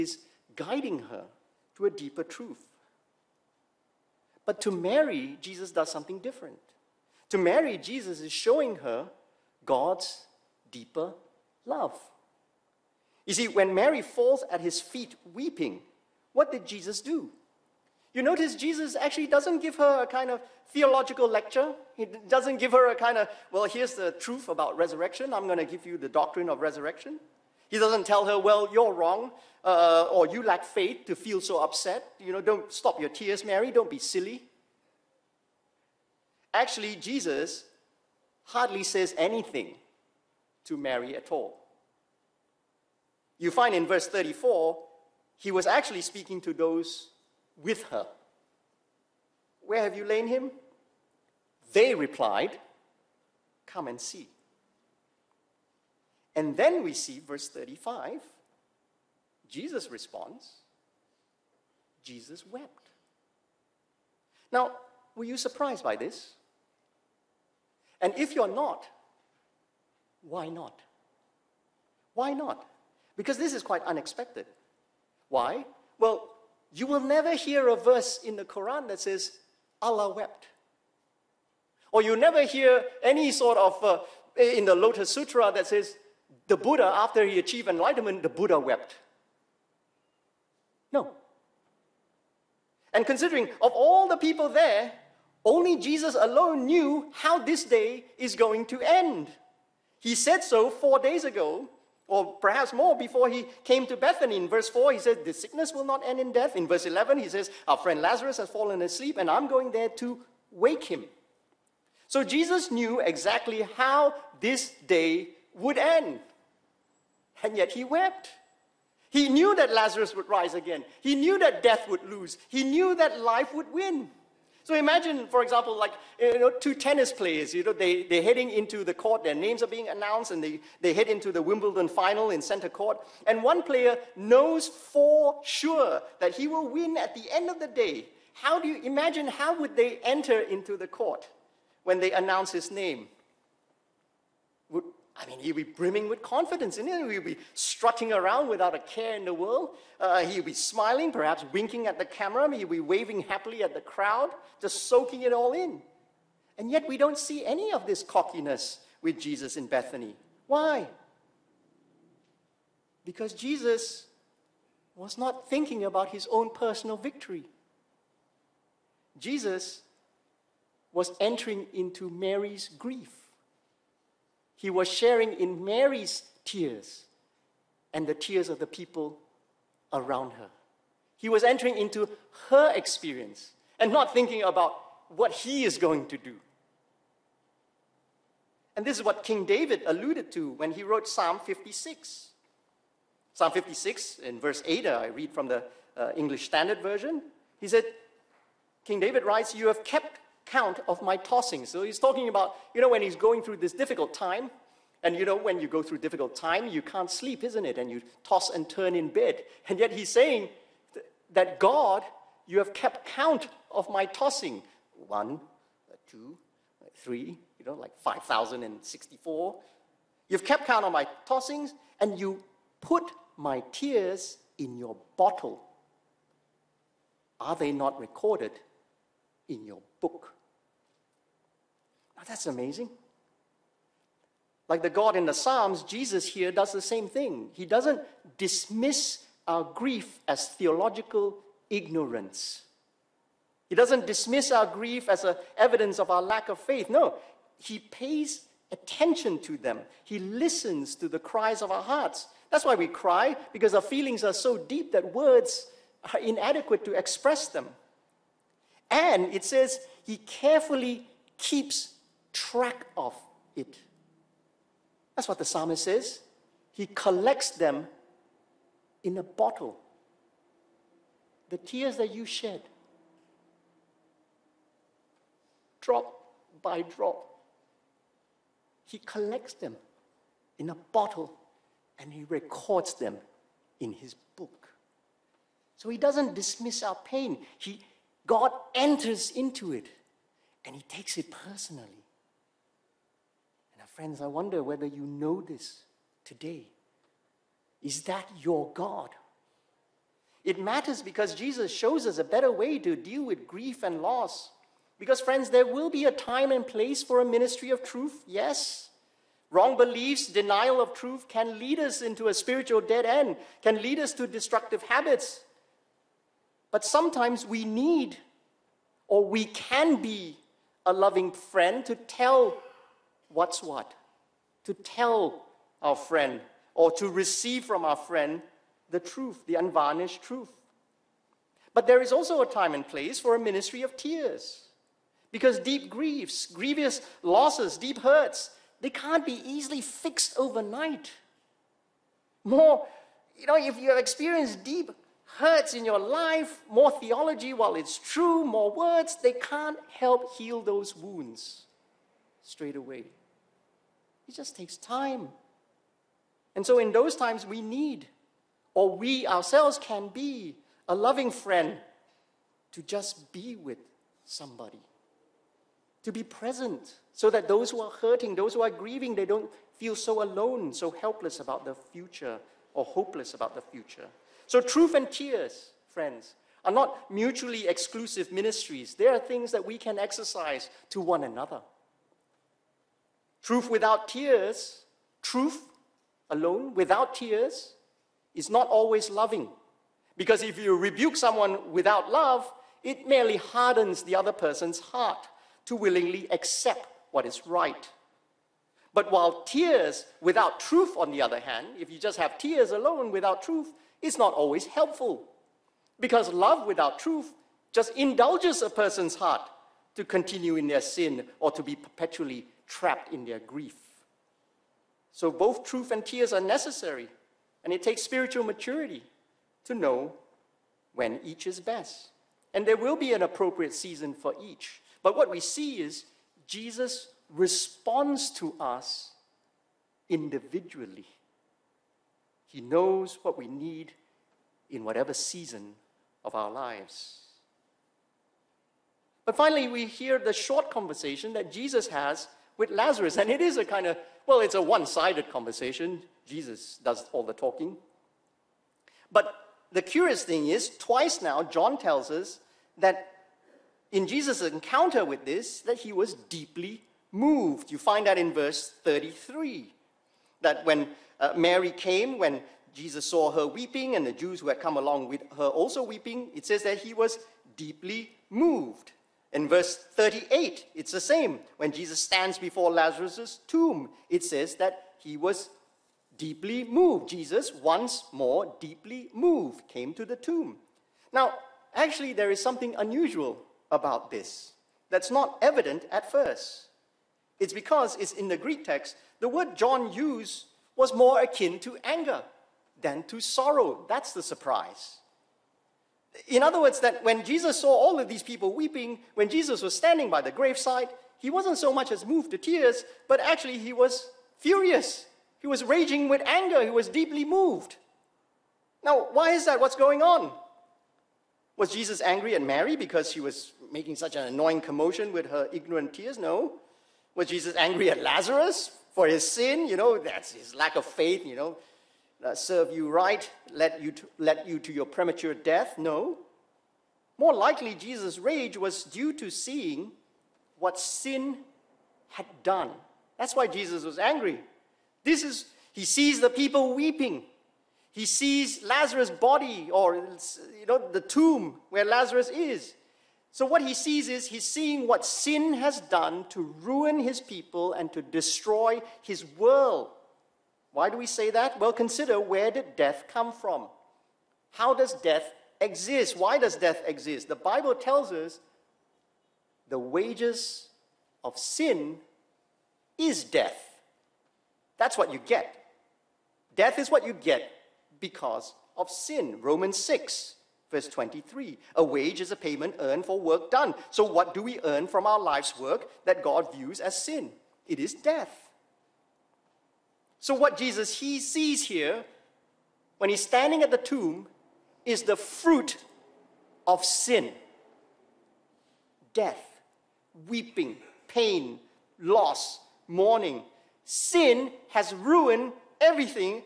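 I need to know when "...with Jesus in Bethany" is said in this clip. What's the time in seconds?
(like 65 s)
159 s.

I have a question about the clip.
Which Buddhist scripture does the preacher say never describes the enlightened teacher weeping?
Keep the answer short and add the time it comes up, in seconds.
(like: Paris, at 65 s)
Lotus Sutra, at 84 s.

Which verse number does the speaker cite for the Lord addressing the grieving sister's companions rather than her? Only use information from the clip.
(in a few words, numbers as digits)
34.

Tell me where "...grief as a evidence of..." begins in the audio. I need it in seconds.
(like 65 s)
244 s.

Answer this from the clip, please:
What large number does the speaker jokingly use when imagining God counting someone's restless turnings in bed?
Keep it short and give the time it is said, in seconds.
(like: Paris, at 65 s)
5,064, at 217 s.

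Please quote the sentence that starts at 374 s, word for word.
So, truth and tears, friends, are not mutually exclusive ministries.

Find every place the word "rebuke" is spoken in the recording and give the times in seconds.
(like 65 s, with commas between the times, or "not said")
390 s.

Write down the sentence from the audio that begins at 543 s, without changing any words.
So, what he sees is he's seeing what sin has done to ruin his people and to destroy his world.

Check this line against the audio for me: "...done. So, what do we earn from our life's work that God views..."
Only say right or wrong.
right.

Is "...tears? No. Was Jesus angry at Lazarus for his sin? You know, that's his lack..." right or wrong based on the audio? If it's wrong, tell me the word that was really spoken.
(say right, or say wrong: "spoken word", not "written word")
right.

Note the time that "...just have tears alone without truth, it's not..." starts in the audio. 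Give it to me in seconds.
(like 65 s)
401 s.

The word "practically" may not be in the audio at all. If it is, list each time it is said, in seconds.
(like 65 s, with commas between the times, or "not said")
not said.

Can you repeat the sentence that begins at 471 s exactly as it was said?
When Jesus stands before Lazarus' tomb, it says that he was deeply moved.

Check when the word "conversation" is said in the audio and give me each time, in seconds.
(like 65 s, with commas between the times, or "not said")
440 s, 445 s.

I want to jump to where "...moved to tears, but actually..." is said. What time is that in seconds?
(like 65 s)
502 s.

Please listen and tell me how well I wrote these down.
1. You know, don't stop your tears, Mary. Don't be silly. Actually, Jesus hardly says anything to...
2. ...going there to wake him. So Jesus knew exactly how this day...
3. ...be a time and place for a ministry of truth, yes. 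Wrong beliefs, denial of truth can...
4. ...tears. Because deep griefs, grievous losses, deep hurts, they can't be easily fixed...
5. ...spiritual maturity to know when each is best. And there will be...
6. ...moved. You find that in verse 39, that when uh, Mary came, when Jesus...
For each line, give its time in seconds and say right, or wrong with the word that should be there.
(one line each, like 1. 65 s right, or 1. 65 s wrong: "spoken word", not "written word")
1. 32 s right
2. 109 s right
3. 305 s right
4. 333 s right
5. 418 s right
6. 457 s wrong: "33", not "39".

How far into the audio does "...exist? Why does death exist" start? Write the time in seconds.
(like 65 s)
555 s.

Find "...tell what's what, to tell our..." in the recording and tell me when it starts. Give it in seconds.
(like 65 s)
321 s.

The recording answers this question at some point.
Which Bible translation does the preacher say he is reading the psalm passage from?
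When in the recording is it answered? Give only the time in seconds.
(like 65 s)
196 s.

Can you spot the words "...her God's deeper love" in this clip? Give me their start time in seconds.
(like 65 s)
8 s.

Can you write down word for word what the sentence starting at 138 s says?
How do you imagine how would they enter into the court when they announce his name?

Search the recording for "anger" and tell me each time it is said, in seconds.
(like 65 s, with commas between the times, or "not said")
491 s, 506 s.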